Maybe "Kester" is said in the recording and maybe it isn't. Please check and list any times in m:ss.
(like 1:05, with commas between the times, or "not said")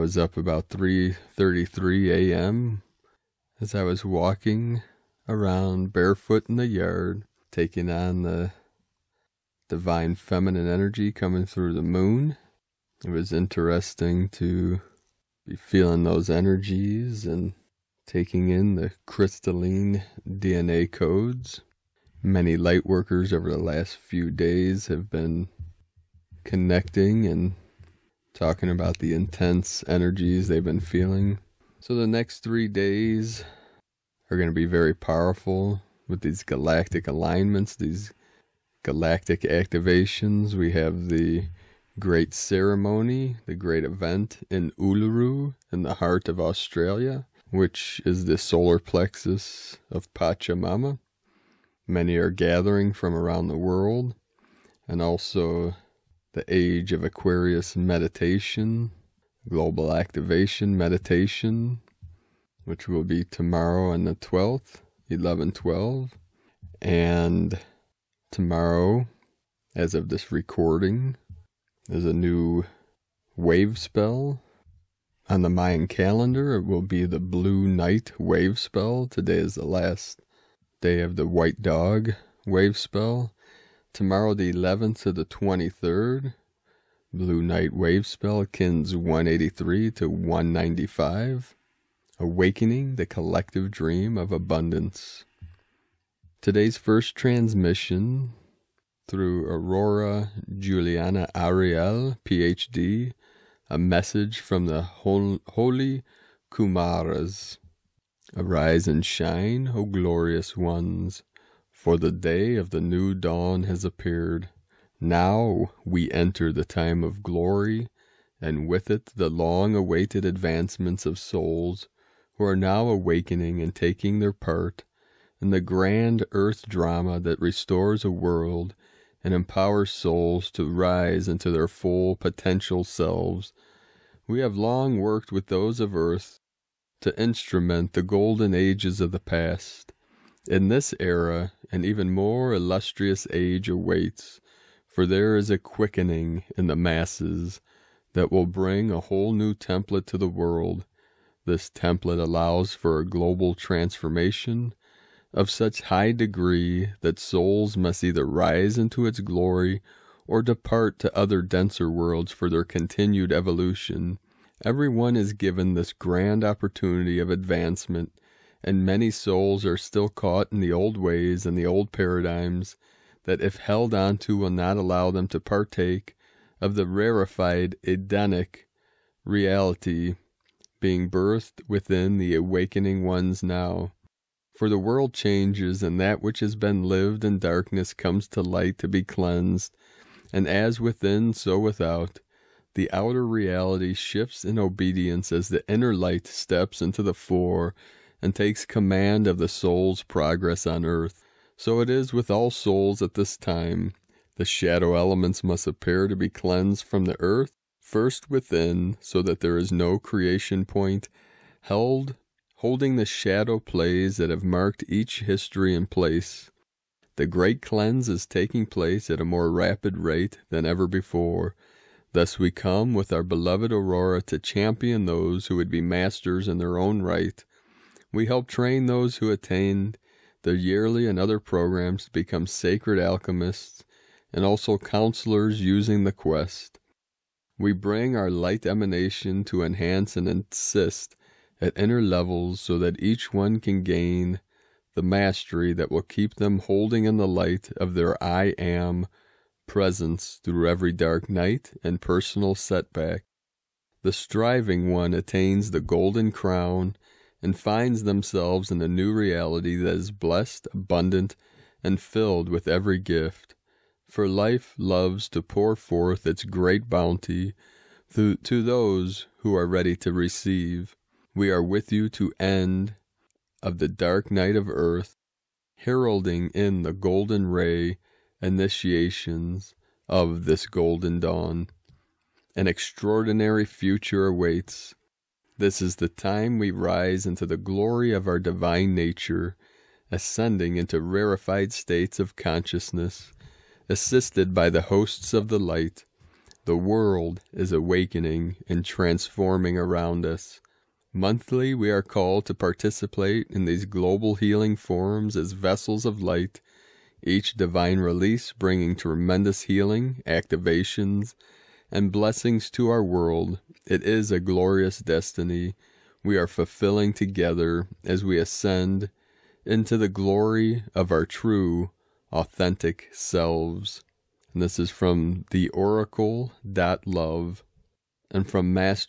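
not said.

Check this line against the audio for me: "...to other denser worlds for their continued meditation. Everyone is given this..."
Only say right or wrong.
wrong.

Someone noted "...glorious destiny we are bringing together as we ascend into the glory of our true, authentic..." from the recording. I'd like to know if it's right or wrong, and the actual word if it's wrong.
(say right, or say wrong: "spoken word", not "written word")
wrong: "fulfilling", not "bringing".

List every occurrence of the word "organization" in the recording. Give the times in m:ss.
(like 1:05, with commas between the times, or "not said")
not said.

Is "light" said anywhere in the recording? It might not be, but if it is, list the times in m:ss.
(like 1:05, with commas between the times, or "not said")
0:22, 3:08, 3:15, 3:58, 4:07, 4:55, 5:06.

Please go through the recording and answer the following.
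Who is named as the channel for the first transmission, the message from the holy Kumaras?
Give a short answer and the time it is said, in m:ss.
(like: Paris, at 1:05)
Aurora Juliana Ariel, at 1:39.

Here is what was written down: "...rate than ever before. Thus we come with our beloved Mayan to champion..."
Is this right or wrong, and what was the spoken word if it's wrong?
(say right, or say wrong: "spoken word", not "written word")
wrong: "Aurora", not "Mayan".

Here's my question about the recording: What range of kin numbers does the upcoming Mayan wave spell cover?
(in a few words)
183 to 195.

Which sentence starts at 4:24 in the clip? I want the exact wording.
For life loves to pour forth its great bounty to, to those who are ready to receive.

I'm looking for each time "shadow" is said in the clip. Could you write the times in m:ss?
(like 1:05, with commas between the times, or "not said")
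3:24, 3:33.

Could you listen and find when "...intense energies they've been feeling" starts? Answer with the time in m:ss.
0:29.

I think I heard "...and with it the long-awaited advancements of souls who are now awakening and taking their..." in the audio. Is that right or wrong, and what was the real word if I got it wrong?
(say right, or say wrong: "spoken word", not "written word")
right.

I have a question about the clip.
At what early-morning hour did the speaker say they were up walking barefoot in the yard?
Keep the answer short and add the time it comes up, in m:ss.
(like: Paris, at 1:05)
3:33 a.m., at 0:00.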